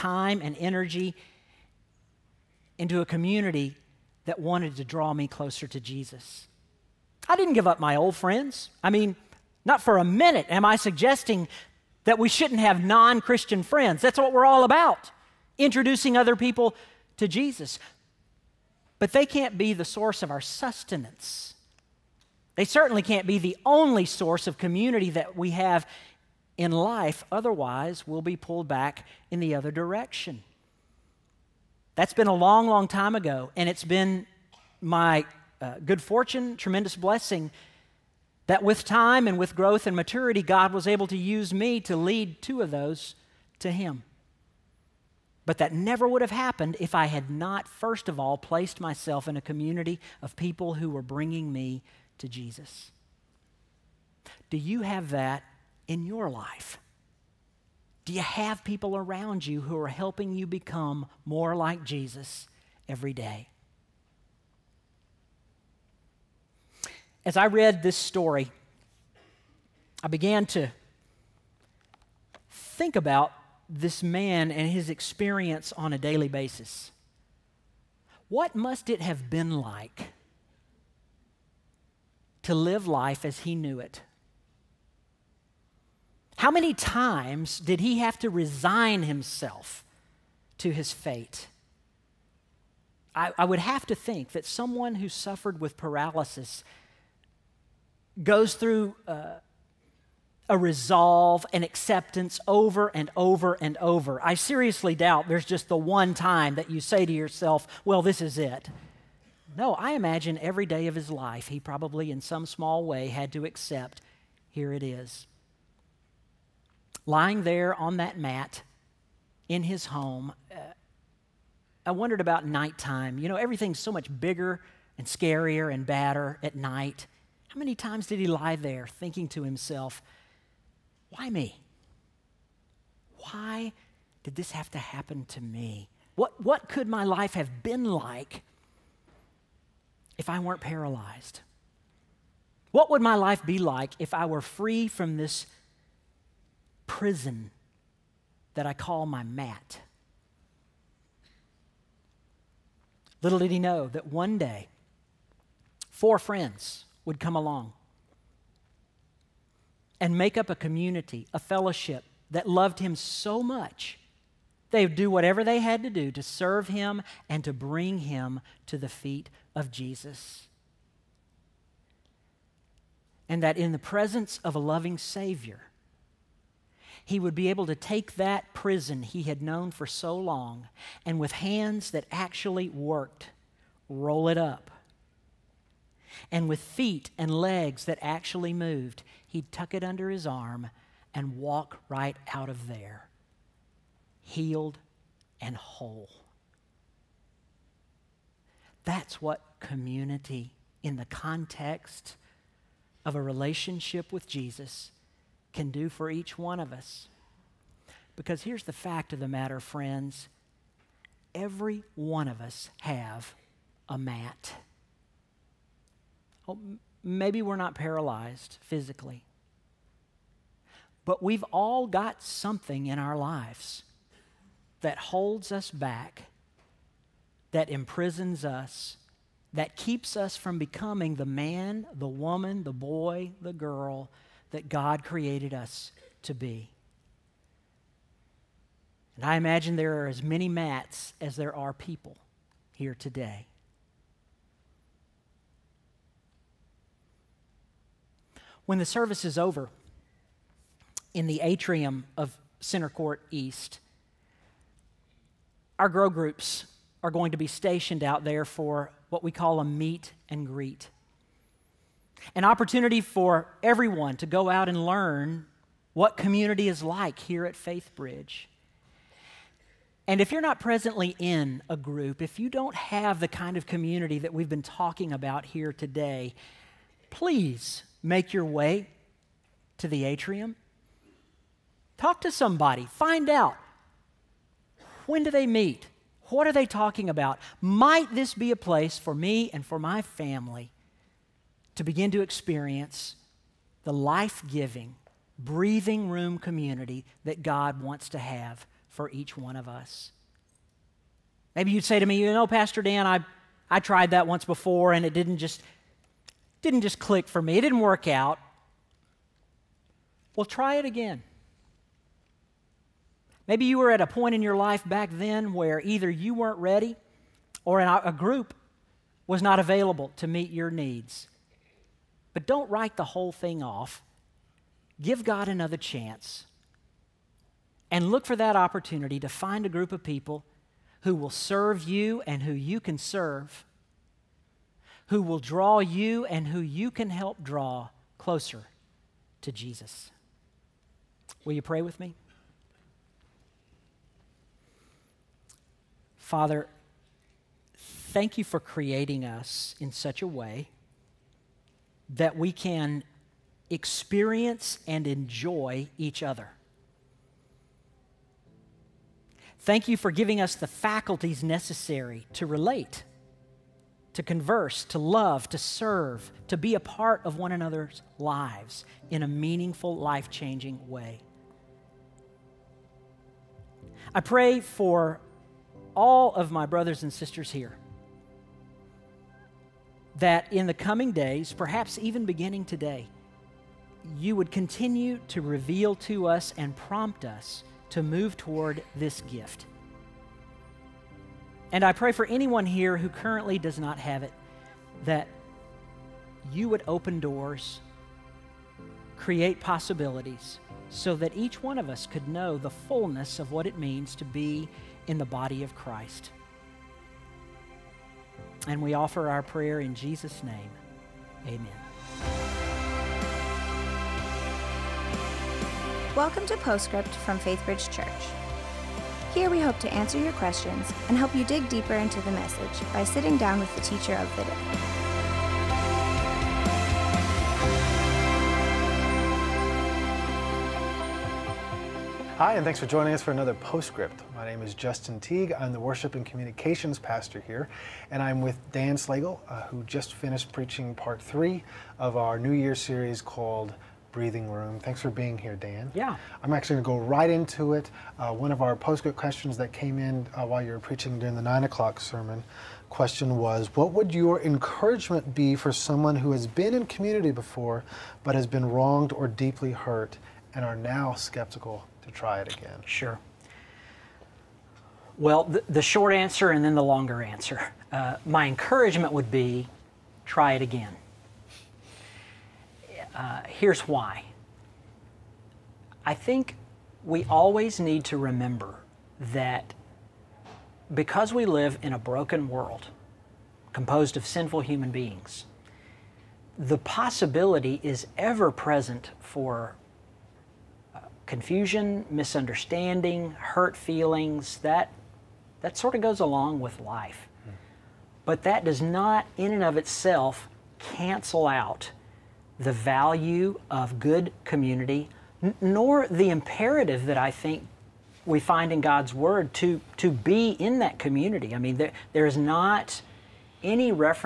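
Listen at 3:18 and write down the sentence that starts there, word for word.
That's what community, in the context of a relationship with Jesus, can do for each one of us.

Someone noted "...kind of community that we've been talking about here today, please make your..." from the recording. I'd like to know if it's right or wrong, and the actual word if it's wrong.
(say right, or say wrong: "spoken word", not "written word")
right.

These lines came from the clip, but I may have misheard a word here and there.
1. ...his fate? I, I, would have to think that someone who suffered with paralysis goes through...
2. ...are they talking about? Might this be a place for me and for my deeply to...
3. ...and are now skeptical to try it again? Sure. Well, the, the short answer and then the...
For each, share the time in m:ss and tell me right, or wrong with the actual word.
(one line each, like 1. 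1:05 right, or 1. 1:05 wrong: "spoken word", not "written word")
1. 1:30 right
2. 4:46 wrong: "family", not "deeply"
3. 7:40 right.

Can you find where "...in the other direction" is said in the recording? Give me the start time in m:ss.
0:29.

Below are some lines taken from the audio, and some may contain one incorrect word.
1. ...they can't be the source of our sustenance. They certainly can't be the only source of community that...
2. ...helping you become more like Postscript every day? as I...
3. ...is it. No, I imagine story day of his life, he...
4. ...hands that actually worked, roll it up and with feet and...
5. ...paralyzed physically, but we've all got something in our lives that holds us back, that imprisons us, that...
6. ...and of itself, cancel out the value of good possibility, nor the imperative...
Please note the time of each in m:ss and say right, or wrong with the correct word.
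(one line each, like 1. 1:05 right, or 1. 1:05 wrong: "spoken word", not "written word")
1. 0:19 right
2. 0:59 wrong: "Jesus", not "Postscript"
3. 1:48 wrong: "every", not "story"
4. 3:01 right
5. 3:37 right
6. 8:19 wrong: "community", not "possibility".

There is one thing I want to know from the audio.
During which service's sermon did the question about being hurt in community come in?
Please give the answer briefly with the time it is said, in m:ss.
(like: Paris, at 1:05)
9 o'clock, at 7:31.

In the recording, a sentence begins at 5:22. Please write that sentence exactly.
But don't write the whole thing off.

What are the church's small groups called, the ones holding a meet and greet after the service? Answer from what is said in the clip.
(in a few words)
grow groups.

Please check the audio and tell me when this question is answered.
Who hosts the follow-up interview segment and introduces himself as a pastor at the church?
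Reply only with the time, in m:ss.
7:14.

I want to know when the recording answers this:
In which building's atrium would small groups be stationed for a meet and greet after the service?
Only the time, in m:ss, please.
4:12.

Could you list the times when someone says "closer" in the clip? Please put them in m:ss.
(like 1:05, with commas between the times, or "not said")
0:05, 5:38.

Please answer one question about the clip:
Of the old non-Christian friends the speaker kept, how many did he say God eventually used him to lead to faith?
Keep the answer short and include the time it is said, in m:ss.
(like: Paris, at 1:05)
2, at 0:42.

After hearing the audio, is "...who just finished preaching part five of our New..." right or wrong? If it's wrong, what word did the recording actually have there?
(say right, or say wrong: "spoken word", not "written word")
wrong: "three", not "five".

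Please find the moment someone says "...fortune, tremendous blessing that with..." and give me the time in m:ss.
0:36.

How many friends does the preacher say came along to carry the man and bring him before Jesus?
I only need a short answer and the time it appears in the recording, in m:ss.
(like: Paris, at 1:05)
4, at 2:35.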